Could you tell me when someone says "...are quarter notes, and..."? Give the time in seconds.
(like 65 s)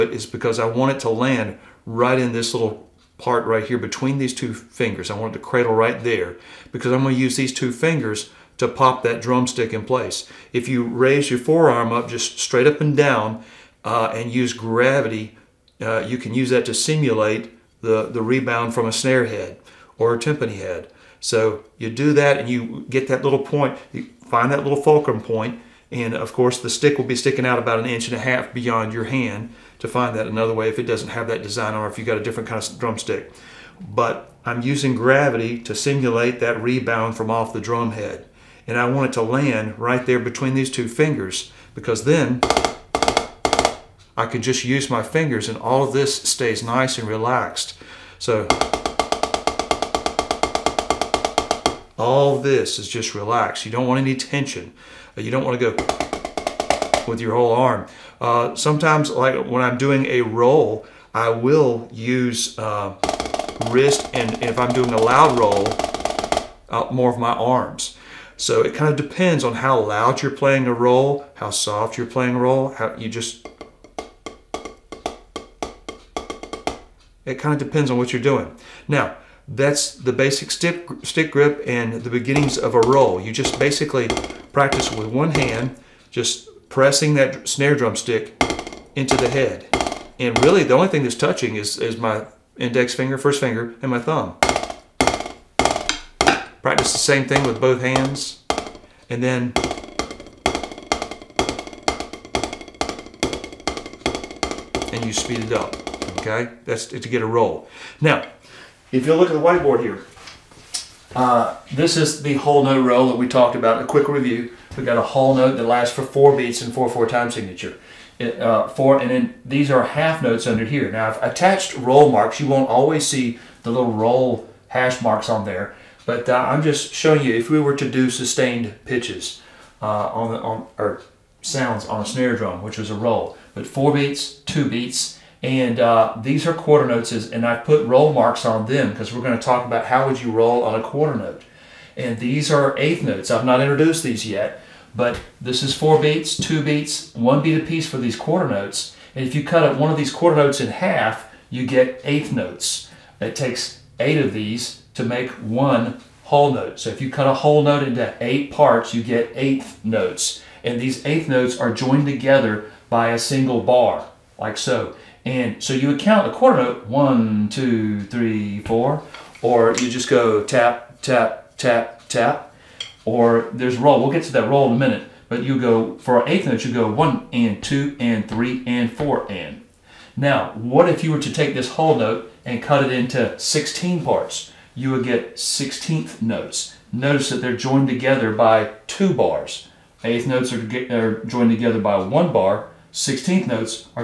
136 s.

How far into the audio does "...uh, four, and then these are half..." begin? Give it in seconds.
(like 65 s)
118 s.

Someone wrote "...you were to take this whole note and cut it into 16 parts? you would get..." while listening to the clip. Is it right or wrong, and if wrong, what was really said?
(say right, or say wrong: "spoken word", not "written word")
right.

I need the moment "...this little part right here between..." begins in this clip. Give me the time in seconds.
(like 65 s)
2 s.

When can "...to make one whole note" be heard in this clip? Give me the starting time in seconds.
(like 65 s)
154 s.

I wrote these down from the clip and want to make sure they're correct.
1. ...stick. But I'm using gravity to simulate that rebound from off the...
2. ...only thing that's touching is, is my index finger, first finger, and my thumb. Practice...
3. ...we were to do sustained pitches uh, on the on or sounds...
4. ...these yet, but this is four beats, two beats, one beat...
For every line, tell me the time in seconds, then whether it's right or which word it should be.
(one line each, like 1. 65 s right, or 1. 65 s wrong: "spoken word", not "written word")
1. 32 s wrong: "drumstick", not "stick"
2. 90 s right
3. 127 s right
4. 144 s right.